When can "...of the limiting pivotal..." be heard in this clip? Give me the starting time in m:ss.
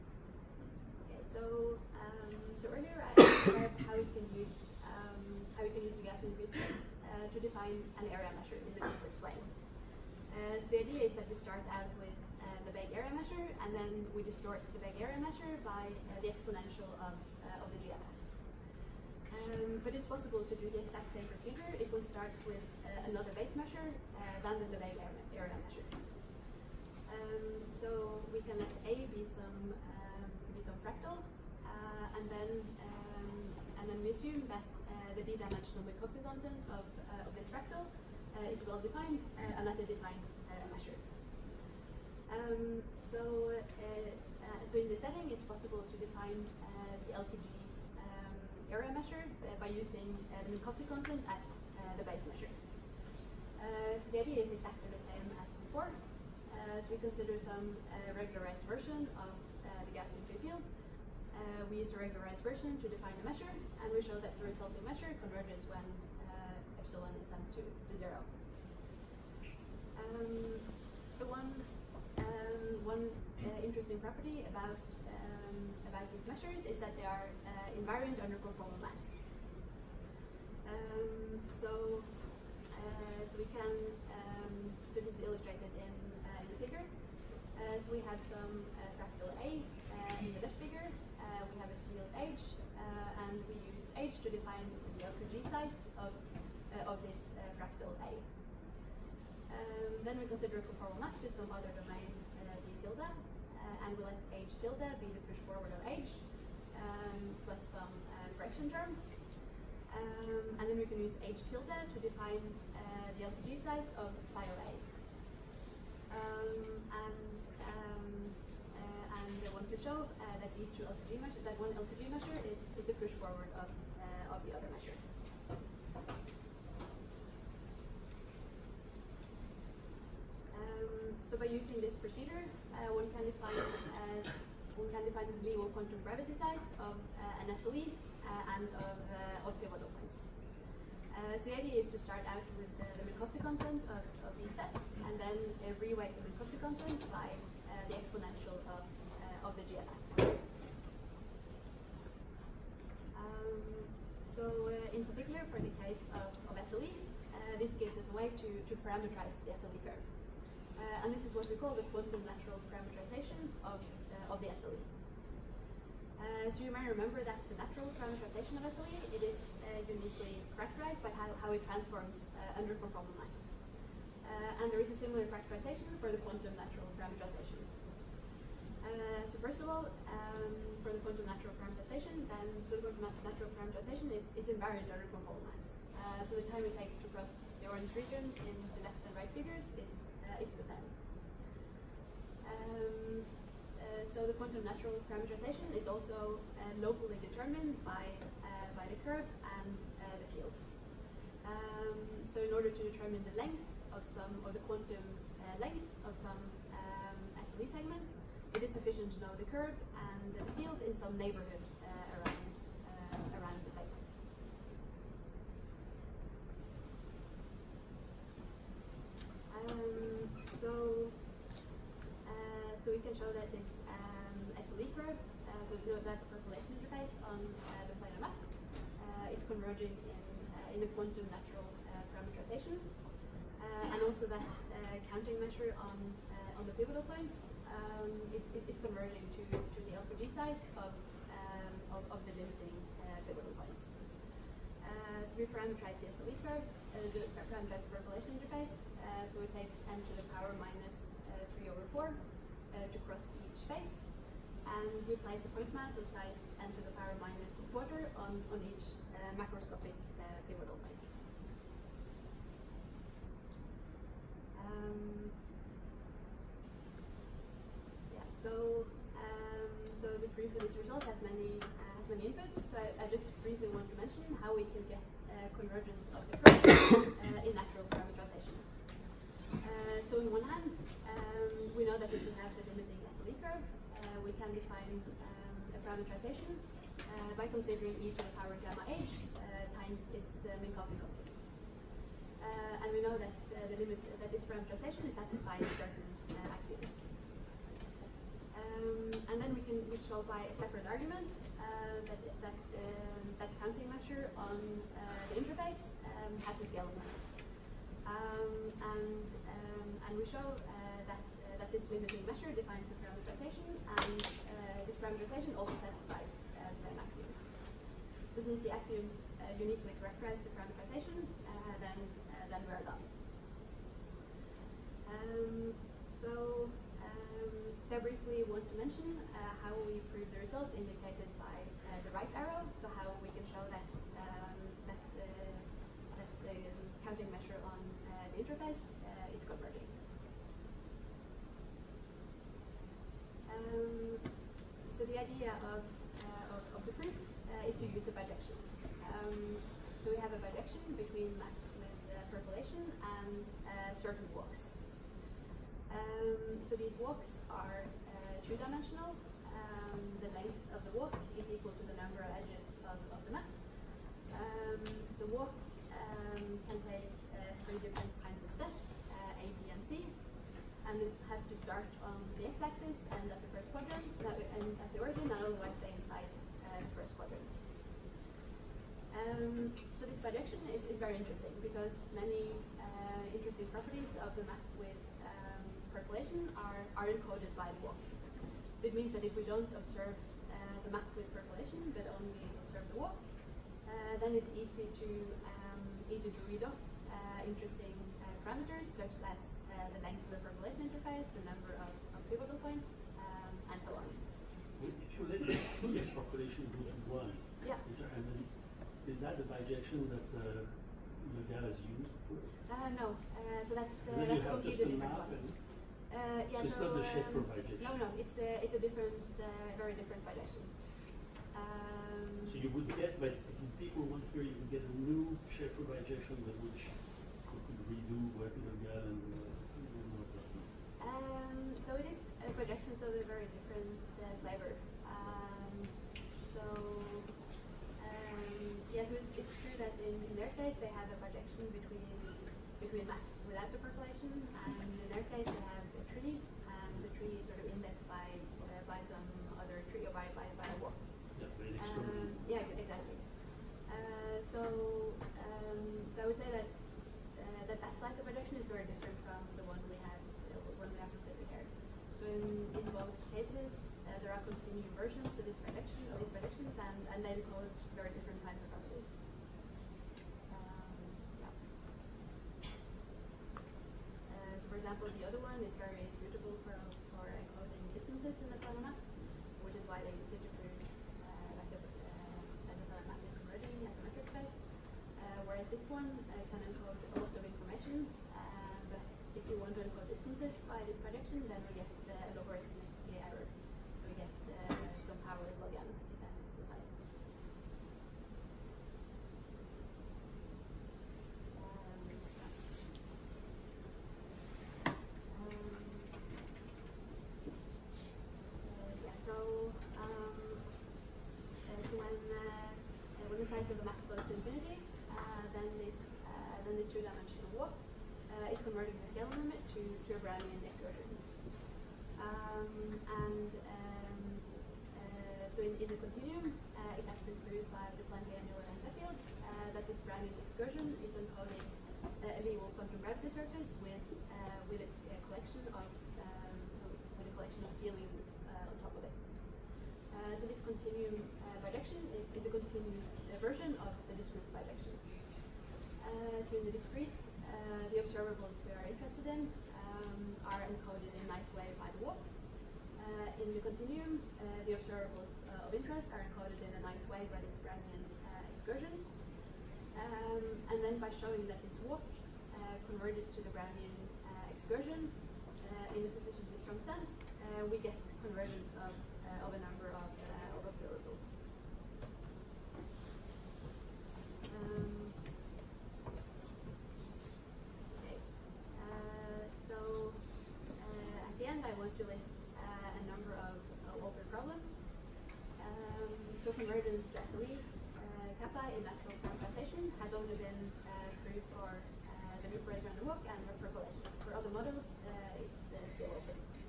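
4:02.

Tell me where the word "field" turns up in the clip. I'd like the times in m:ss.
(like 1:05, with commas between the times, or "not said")
1:00, 1:31, 3:20, 3:30.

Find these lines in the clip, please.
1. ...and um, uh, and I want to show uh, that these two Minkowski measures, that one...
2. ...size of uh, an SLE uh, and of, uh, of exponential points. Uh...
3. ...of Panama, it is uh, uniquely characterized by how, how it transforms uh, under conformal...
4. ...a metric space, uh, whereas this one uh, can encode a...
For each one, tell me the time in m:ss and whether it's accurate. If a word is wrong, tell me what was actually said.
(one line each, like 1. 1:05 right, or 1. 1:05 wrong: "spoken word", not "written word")
1. 1:57 wrong: "LQG", not "Minkowski"
2. 2:16 wrong: "pivotal", not "exponential"
3. 2:48 wrong: "SLE", not "Panama"
4. 8:03 right.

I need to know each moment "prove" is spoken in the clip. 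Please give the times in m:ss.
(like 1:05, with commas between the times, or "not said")
5:30, 8:00.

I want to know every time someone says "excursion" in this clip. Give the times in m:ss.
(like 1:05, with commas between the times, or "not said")
9:18, 9:24.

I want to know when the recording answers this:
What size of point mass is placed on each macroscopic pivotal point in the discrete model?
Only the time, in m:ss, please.
4:16.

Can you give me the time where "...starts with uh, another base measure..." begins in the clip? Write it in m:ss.
0:22.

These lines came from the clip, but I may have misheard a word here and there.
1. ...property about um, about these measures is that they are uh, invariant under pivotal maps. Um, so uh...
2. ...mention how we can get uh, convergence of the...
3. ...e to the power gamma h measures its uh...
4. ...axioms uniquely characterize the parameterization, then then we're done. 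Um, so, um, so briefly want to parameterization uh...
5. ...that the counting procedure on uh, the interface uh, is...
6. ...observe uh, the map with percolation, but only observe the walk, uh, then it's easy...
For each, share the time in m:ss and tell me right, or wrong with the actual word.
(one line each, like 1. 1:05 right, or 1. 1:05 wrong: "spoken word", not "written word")
1. 1:13 wrong: "conformal", not "pivotal"
2. 4:33 right
3. 4:47 wrong: "times", not "measures"
4. 5:18 wrong: "mention", not "parameterization"
5. 5:36 wrong: "measure", not "procedure"
6. 6:29 right.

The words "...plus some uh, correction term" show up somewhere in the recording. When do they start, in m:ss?
1:47.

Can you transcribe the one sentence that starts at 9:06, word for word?
so in the discrete, the observables we are interested in um, are encoded in a nice way by the walk.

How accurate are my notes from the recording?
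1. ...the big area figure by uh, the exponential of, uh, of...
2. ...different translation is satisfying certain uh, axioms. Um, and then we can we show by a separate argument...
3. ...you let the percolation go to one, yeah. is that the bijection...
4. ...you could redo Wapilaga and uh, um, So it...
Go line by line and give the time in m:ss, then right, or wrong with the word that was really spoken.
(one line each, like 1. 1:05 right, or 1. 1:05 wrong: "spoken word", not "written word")
1. 0:14 wrong: "measure", not "figure"
2. 4:54 right
3. 6:45 right
4. 7:06 right.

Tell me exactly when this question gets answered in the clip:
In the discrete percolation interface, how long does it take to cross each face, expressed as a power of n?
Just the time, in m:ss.
4:09.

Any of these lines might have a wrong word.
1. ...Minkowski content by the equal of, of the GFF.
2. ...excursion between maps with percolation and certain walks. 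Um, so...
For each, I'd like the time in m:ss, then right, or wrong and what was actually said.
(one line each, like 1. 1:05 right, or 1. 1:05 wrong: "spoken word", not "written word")
1. 2:26 wrong: "exponential", not "equal"
2. 5:50 wrong: "bijection", not "excursion".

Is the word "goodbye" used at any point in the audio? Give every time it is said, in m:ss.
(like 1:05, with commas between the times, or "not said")
not said.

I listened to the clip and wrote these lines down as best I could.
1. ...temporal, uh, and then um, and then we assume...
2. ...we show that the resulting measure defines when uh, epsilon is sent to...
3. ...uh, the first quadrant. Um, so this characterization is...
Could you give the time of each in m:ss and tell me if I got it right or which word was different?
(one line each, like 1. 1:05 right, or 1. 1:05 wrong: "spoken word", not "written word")
1. 0:30 wrong: "fractal", not "temporal"
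2. 1:03 wrong: "converges", not "defines"
3. 6:16 wrong: "projection", not "characterization".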